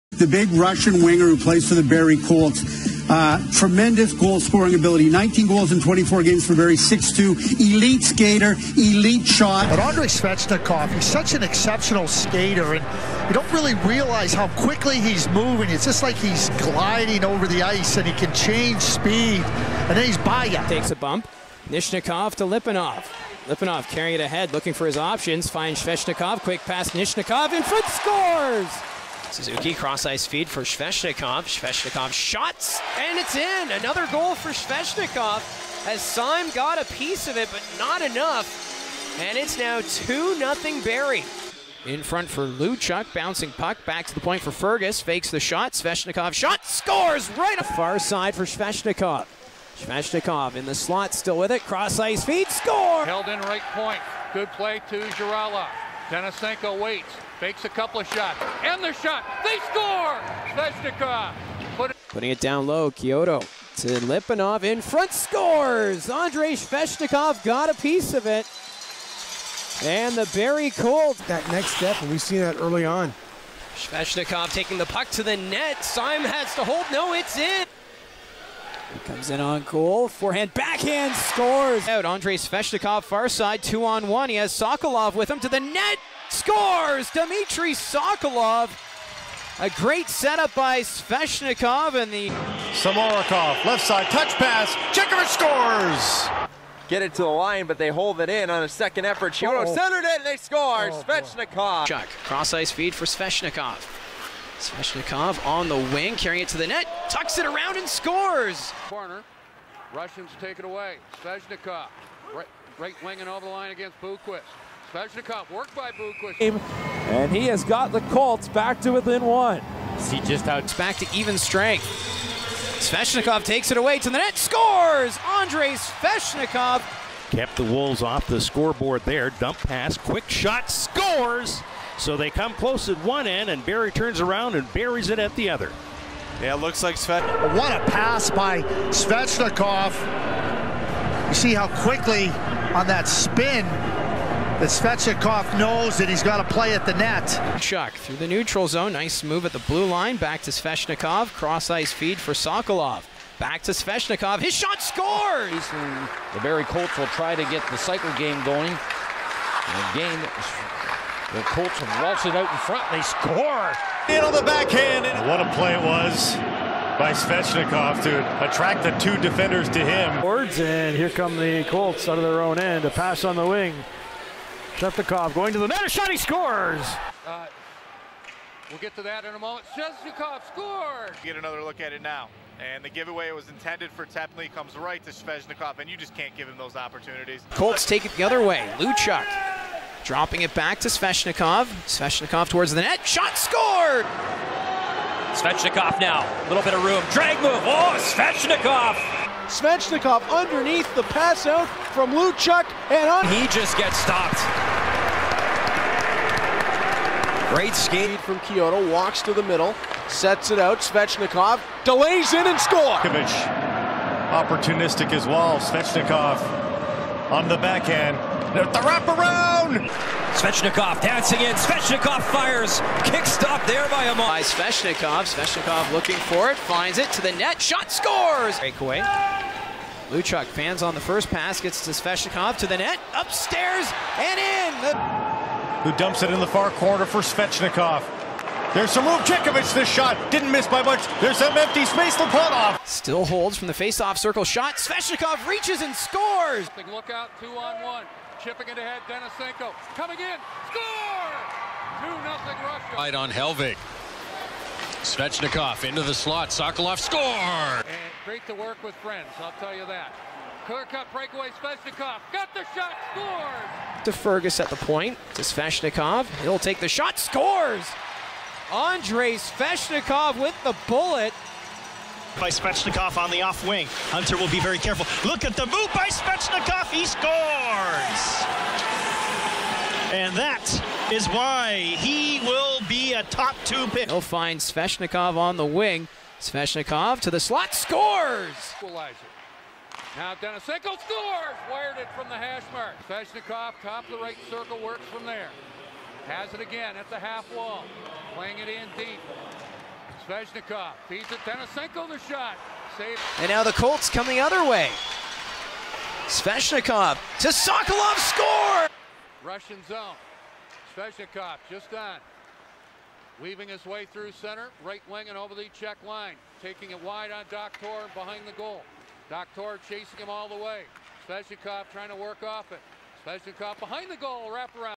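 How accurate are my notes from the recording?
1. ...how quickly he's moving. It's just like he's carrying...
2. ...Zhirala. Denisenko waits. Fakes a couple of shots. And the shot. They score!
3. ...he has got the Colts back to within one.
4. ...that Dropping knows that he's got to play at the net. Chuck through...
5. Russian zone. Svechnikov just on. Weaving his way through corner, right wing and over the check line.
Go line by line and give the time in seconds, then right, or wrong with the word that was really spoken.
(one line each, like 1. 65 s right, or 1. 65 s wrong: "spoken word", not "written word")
1. 14 s wrong: "gliding", not "carrying"
2. 54 s right
3. 117 s right
4. 143 s wrong: "Svechnikov", not "Dropping"
5. 309 s wrong: "center", not "corner".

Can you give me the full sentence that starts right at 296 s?
Has it again at the half wall.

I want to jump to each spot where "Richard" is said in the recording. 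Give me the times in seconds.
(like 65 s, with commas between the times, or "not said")
not said.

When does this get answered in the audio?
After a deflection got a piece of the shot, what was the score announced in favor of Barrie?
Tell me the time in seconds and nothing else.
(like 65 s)
39 s.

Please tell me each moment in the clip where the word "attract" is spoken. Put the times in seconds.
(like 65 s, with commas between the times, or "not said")
168 s.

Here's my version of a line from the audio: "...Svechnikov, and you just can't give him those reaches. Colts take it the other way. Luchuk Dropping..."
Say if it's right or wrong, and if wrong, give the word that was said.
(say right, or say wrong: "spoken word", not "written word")
wrong: "opportunities", not "reaches".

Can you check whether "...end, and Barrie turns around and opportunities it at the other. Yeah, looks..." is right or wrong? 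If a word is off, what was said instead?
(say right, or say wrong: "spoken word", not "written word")
wrong: "buries", not "opportunities".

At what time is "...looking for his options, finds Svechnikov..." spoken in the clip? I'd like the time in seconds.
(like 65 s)
24 s.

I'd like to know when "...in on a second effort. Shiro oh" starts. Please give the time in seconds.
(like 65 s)
98 s.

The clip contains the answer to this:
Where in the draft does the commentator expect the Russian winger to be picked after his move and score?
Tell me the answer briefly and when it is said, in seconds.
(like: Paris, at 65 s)
top two pick, at 283 s.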